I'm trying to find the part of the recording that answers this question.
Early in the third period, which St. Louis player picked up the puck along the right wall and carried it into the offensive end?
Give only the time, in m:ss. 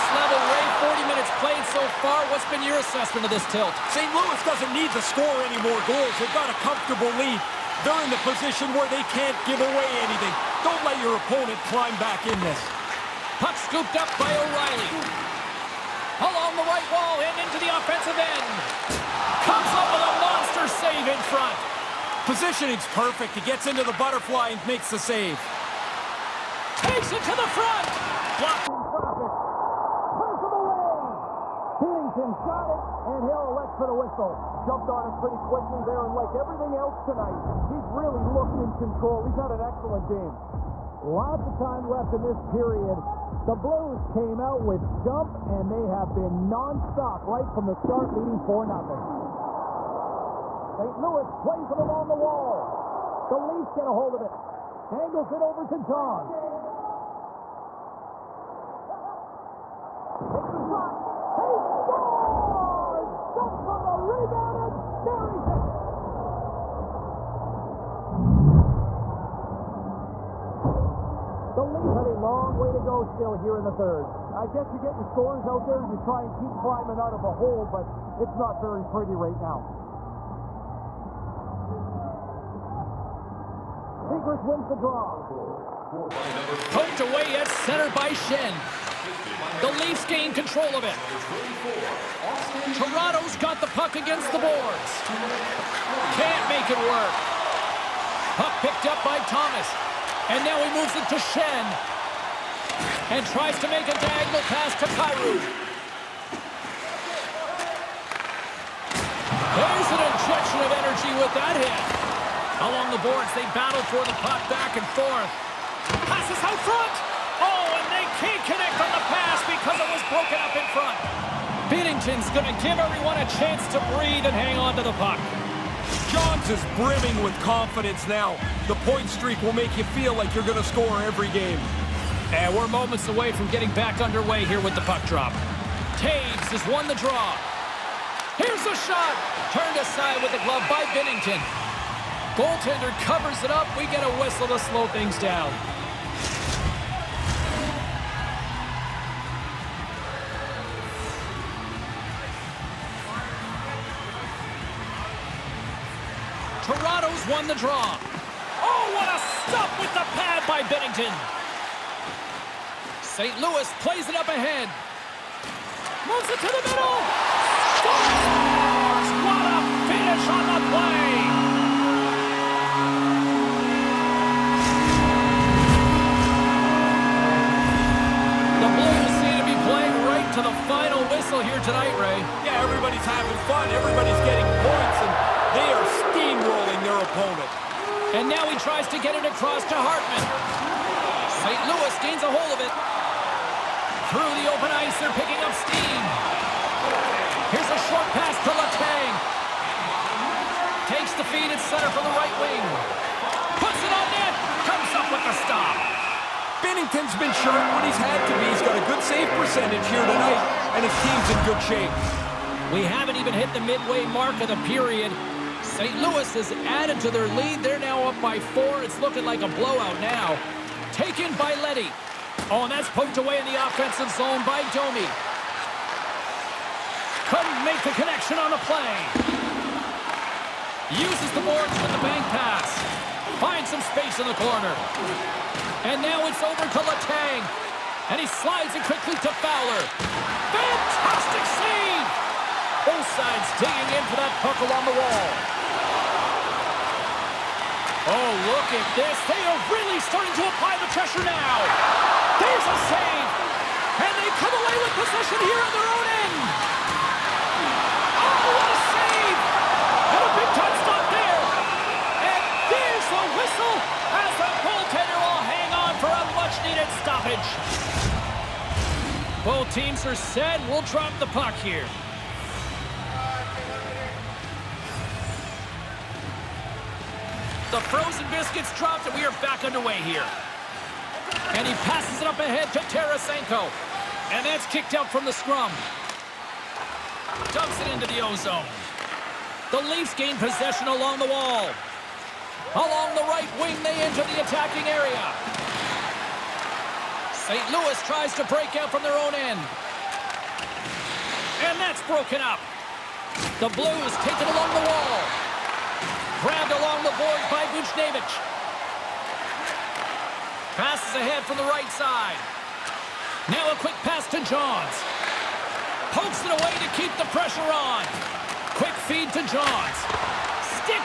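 0:14.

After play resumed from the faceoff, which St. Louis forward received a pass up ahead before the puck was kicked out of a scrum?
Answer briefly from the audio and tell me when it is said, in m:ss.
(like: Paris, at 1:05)
Tarasenko, at 4:42.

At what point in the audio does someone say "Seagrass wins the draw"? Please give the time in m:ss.
1:24.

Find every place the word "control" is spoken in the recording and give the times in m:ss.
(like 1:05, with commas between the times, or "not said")
0:38, 1:30.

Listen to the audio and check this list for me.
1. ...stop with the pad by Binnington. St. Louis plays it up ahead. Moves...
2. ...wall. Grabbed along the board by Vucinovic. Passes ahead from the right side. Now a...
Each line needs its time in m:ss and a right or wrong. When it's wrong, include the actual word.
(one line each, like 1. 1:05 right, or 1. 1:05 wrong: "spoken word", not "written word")
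1. 2:39 right
2. 5:04 right.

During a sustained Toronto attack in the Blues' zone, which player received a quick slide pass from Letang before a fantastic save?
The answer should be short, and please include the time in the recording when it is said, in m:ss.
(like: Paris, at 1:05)
Fowler, at 3:59.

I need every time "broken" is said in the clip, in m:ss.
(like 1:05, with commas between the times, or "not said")
2:00, 5:02.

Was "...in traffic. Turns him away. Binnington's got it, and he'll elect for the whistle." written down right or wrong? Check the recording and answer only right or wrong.
right.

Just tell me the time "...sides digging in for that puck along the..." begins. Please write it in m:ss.
4:03.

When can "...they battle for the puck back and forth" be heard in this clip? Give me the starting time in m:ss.
1:53.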